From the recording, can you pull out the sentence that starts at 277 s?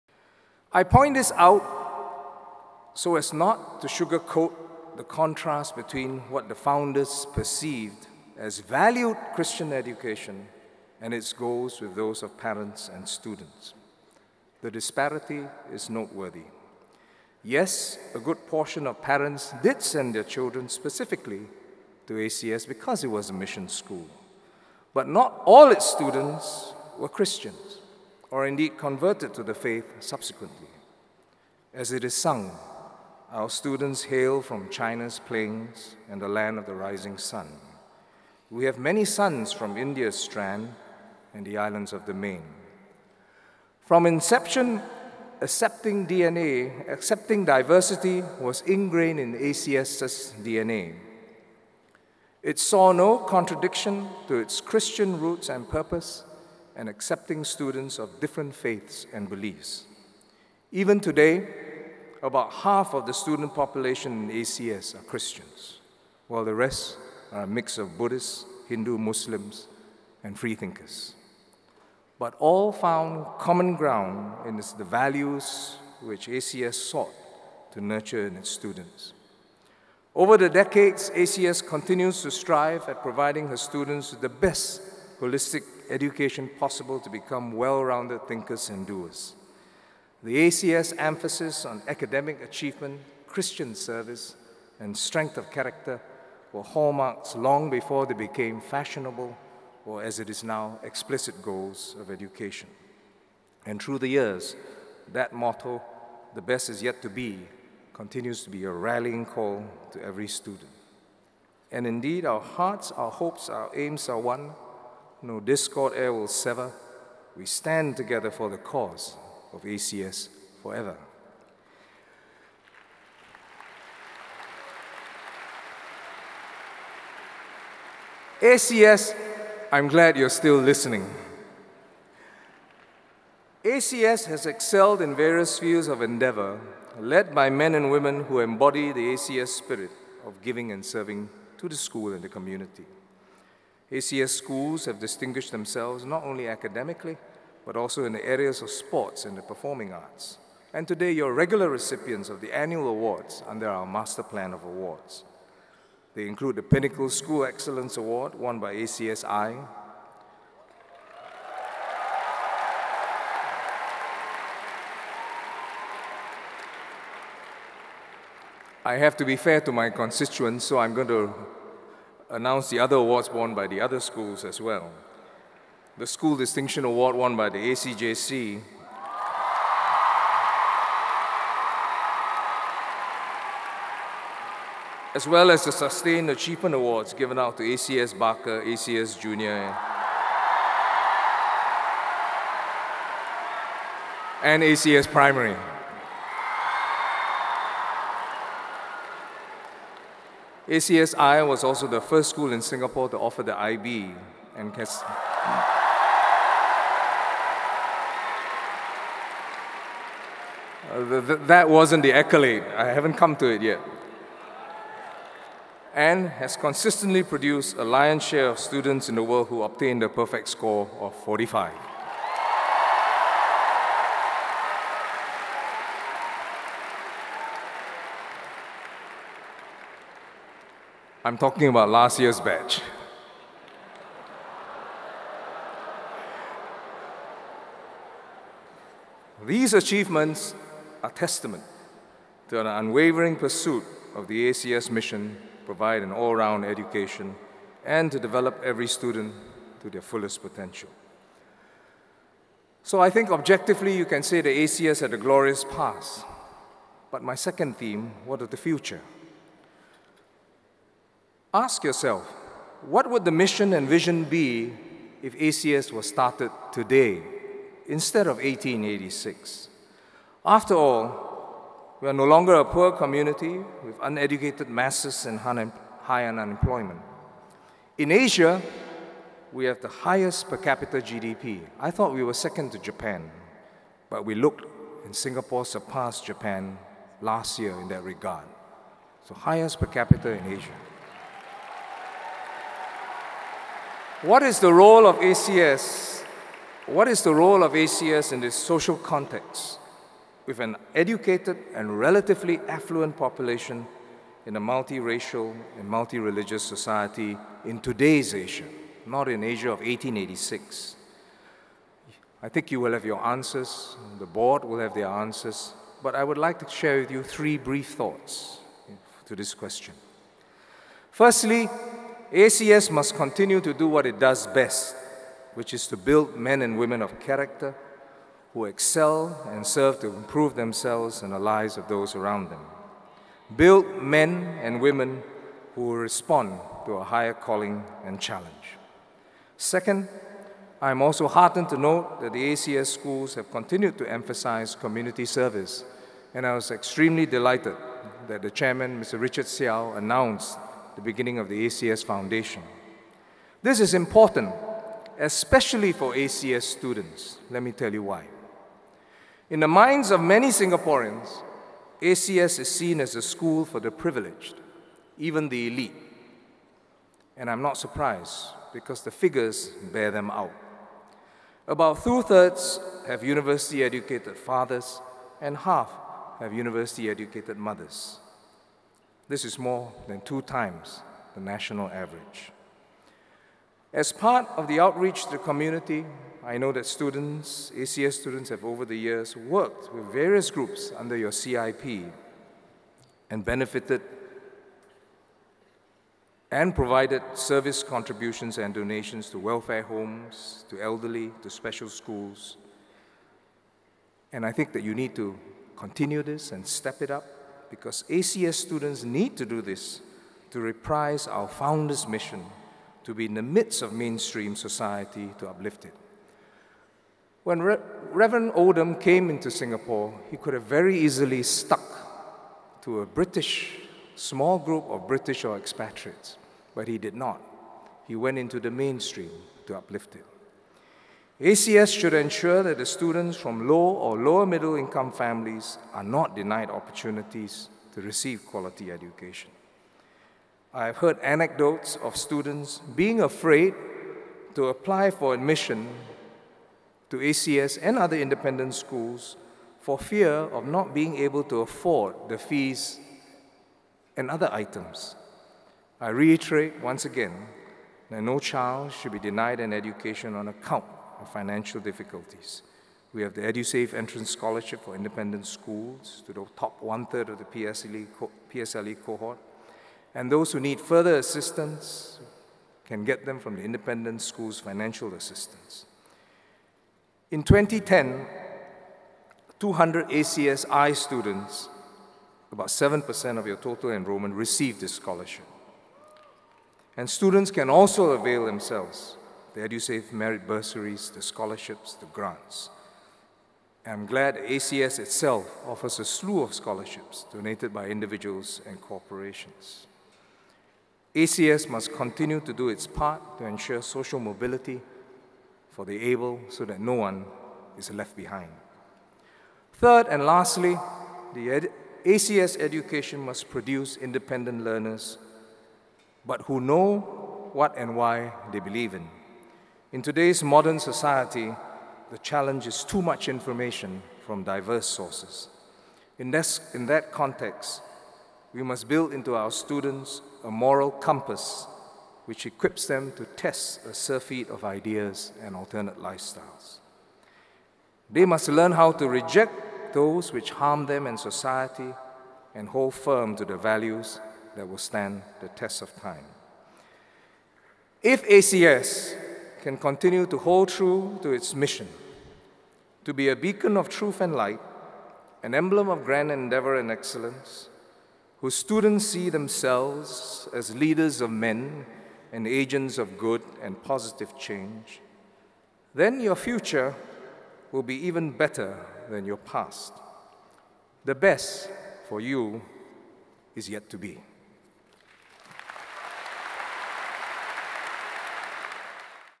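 In Asia, we have the highest per capita GDP.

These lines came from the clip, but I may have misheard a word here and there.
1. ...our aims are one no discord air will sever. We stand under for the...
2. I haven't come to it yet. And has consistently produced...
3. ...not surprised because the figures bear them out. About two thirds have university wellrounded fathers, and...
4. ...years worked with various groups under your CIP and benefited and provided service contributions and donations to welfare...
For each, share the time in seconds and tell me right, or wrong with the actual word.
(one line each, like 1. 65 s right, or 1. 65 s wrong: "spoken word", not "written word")
1. 113 s wrong: "together", not "under"
2. 212 s right
3. 367 s wrong: "educated", not "wellrounded"
4. 388 s right.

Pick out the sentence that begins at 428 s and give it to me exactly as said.
He went into the mainstream to uplift it.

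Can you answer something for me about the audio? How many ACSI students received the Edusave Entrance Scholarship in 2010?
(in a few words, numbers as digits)
200.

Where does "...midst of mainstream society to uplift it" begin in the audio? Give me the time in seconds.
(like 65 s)
413 s.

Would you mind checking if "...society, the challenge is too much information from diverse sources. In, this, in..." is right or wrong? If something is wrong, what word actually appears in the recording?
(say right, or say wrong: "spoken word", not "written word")
right.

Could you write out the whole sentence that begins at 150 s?
And today, you're regular recipients of the annual awards under our Master Plan of Awards.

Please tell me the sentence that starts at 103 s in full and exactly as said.
And through the years, that motto, the best is yet to be, continues to be a rallying call to every student.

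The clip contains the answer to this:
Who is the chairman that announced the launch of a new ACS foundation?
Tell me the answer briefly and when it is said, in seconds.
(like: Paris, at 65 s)
Richard Seow, at 349 s.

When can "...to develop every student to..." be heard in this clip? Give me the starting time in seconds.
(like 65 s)
248 s.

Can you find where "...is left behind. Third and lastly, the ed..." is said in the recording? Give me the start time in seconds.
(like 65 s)
507 s.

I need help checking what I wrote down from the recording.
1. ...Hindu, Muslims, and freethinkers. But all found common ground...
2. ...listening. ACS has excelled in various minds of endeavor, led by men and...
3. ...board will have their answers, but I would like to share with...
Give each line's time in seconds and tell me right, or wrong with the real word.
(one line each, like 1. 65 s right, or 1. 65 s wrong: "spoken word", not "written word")
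1. 68 s right
2. 130 s wrong: "fields", not "minds"
3. 314 s right.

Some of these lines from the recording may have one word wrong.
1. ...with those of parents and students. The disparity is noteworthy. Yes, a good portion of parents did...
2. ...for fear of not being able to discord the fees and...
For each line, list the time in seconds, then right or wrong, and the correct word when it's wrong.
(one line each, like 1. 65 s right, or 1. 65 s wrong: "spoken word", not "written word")
1. 11 s right
2. 449 s wrong: "afford", not "discord".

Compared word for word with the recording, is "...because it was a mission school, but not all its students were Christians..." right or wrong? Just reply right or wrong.
right.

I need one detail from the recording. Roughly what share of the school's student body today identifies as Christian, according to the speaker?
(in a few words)
about half.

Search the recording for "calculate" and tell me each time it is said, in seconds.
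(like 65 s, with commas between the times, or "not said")
not said.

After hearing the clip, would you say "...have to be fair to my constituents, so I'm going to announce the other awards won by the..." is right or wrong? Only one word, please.
right.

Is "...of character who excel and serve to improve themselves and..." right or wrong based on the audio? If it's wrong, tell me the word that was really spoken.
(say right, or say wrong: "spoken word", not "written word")
right.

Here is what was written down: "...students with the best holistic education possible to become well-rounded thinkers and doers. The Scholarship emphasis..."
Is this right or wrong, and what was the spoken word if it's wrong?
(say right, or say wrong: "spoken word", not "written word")
wrong: "ACS", not "Scholarship".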